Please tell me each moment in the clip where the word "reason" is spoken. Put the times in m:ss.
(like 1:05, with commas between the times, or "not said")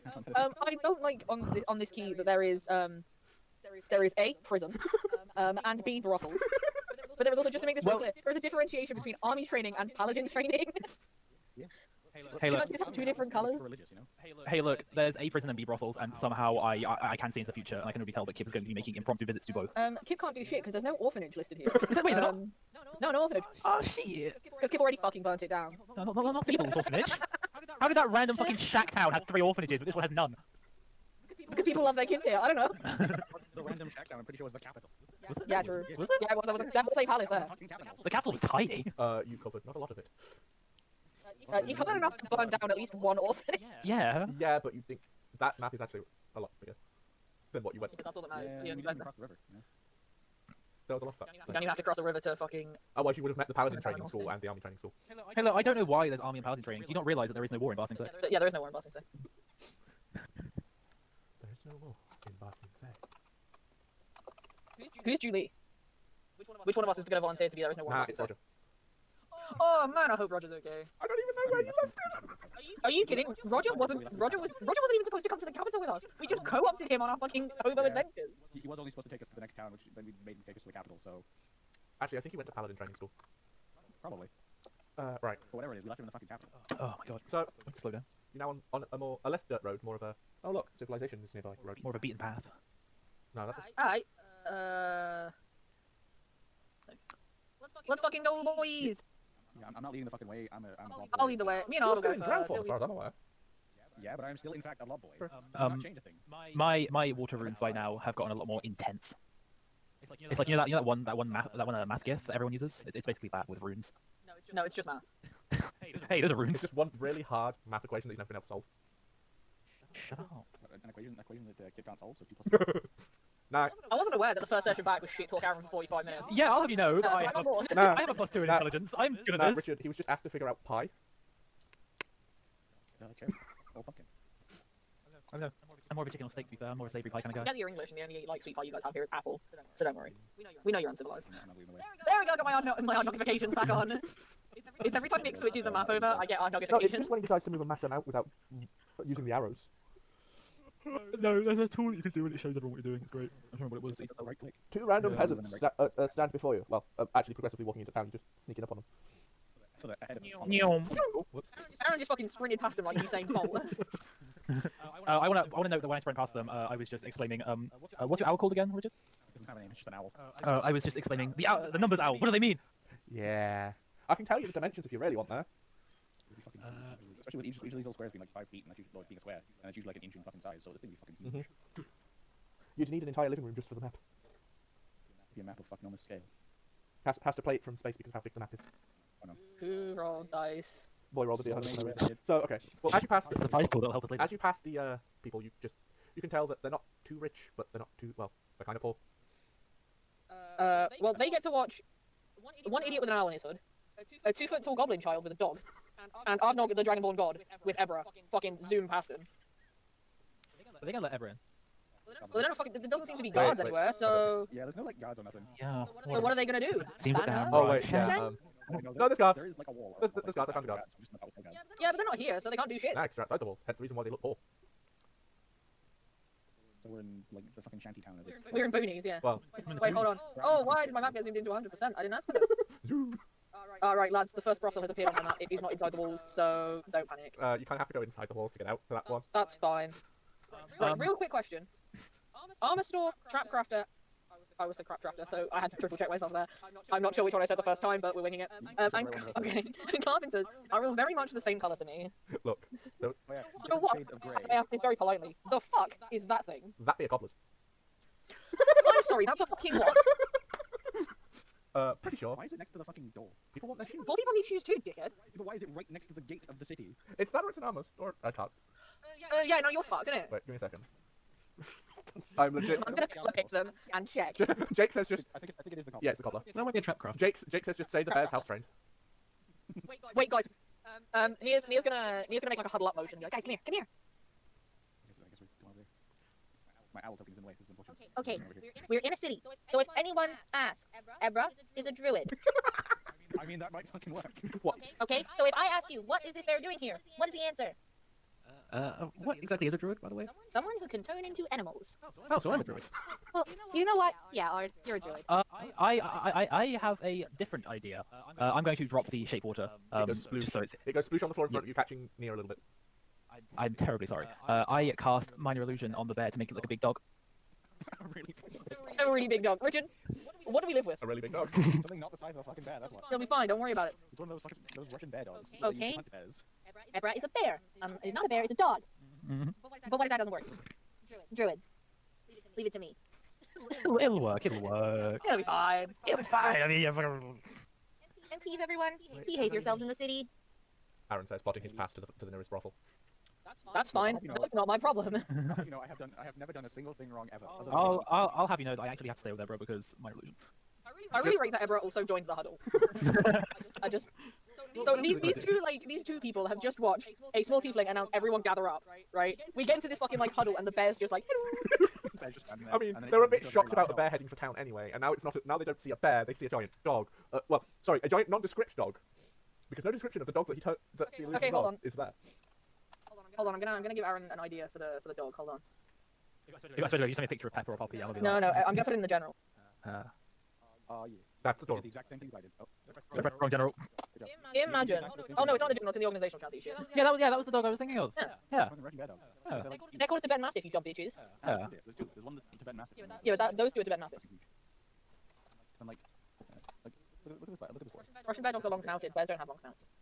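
3:11, 3:43.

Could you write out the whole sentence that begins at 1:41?
Me and Otto go in drown form, as far as I'm aware.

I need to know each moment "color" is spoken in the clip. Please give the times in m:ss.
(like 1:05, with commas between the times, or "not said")
0:13, 4:11, 4:33.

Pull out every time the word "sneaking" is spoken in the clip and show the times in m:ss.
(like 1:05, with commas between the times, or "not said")
2:38.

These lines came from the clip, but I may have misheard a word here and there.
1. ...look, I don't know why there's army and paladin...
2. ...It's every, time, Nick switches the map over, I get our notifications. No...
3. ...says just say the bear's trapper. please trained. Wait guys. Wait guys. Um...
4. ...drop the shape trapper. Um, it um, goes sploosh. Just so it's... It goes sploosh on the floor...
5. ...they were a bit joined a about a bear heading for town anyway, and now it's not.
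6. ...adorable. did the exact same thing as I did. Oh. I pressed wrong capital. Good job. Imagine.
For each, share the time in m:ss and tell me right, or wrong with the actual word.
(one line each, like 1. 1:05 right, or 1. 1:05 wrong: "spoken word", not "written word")
1. 0:55 right
2. 2:24 right
3. 4:37 wrong: "house", not "please"
4. 5:08 wrong: "water", not "trapper"
5. 6:03 wrong: "shocked", not "joined"
6. 6:21 wrong: "general", not "capital".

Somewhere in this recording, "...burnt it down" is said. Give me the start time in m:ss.
0:25.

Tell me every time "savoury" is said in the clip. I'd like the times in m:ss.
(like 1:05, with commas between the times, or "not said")
2:16.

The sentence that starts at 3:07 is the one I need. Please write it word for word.
Has has to play it from space because of how big the map is.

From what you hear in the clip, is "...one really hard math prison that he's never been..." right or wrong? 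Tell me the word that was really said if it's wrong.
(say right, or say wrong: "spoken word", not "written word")
wrong: "equation", not "prison".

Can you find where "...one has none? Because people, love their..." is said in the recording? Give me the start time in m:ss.
0:29.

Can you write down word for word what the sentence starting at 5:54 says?
So these these two like these two people have just watched a small tiefling announce everyone gather up right?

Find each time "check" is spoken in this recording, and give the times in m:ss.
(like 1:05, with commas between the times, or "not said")
4:05, 4:34.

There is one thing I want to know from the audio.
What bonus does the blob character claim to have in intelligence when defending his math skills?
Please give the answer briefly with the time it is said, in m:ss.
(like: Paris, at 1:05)
Plus two, at 2:08.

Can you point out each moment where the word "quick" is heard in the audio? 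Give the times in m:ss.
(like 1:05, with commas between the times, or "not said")
4:01.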